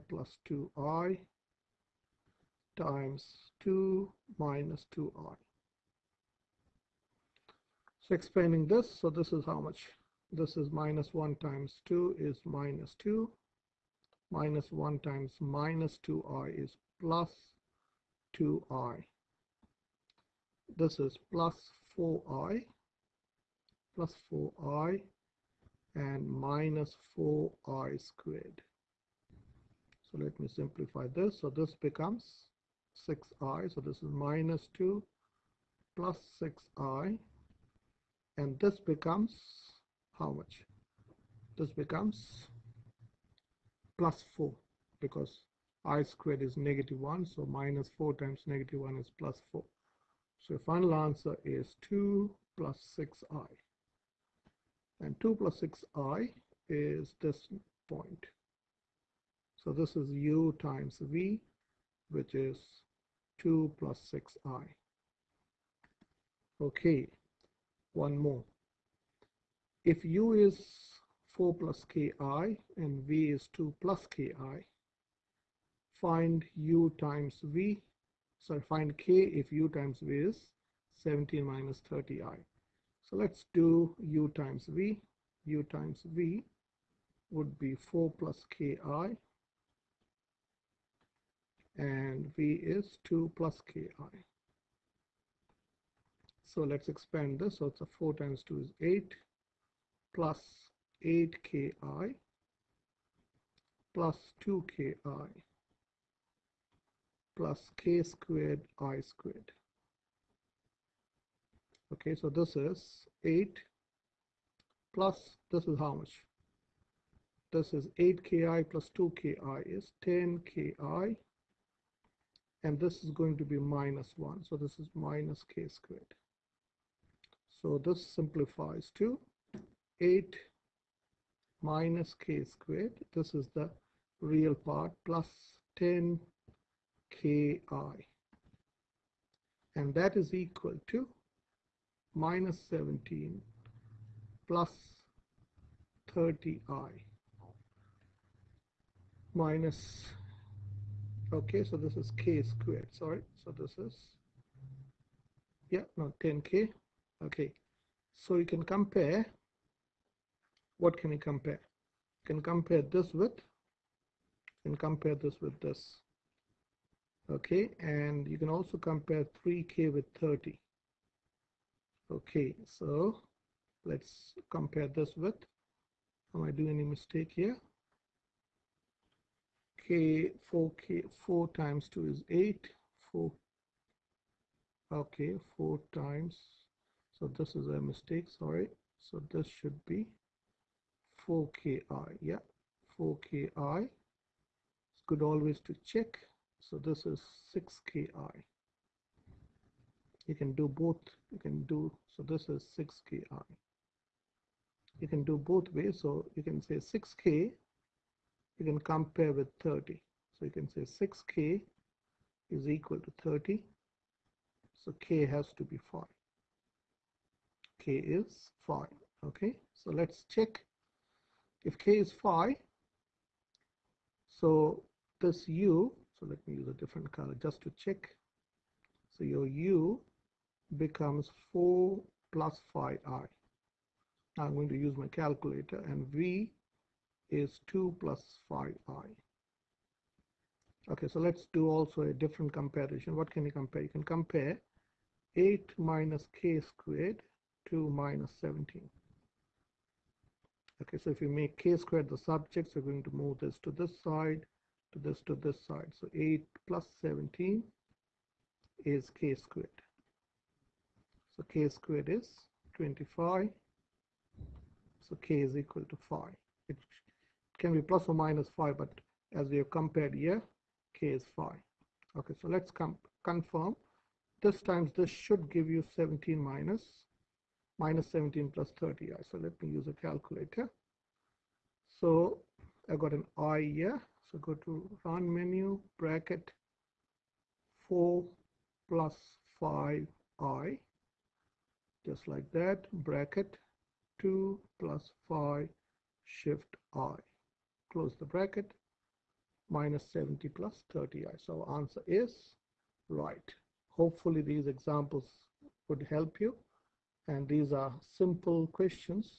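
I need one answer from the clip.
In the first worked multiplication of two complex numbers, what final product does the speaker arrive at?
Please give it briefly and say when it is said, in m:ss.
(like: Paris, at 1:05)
2 + 6i, at 0:50.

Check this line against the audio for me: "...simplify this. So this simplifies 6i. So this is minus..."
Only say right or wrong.
wrong.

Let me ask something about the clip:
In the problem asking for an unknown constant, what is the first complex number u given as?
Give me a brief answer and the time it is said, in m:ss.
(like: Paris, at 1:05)
4 + ki, at 1:10.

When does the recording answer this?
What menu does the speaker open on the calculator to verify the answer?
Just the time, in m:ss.
4:45.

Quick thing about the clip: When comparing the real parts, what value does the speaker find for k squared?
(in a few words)
25.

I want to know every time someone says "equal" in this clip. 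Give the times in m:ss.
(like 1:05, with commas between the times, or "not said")
2:20, 3:32, 4:25.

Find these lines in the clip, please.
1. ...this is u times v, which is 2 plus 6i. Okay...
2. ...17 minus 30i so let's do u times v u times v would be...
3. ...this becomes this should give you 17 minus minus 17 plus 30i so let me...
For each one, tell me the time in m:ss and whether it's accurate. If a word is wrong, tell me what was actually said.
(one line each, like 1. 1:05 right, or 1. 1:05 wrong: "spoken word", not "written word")
1. 0:59 right
2. 1:21 right
3. 4:34 wrong: "times", not "becomes".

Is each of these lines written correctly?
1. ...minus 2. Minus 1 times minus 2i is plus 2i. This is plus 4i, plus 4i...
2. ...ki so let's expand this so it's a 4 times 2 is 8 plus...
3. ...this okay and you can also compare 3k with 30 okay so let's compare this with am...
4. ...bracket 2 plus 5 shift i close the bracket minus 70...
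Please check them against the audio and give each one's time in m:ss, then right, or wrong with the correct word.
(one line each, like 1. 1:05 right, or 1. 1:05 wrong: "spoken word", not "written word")
1. 0:12 right
2. 1:33 right
3. 2:45 right
4. 4:53 right.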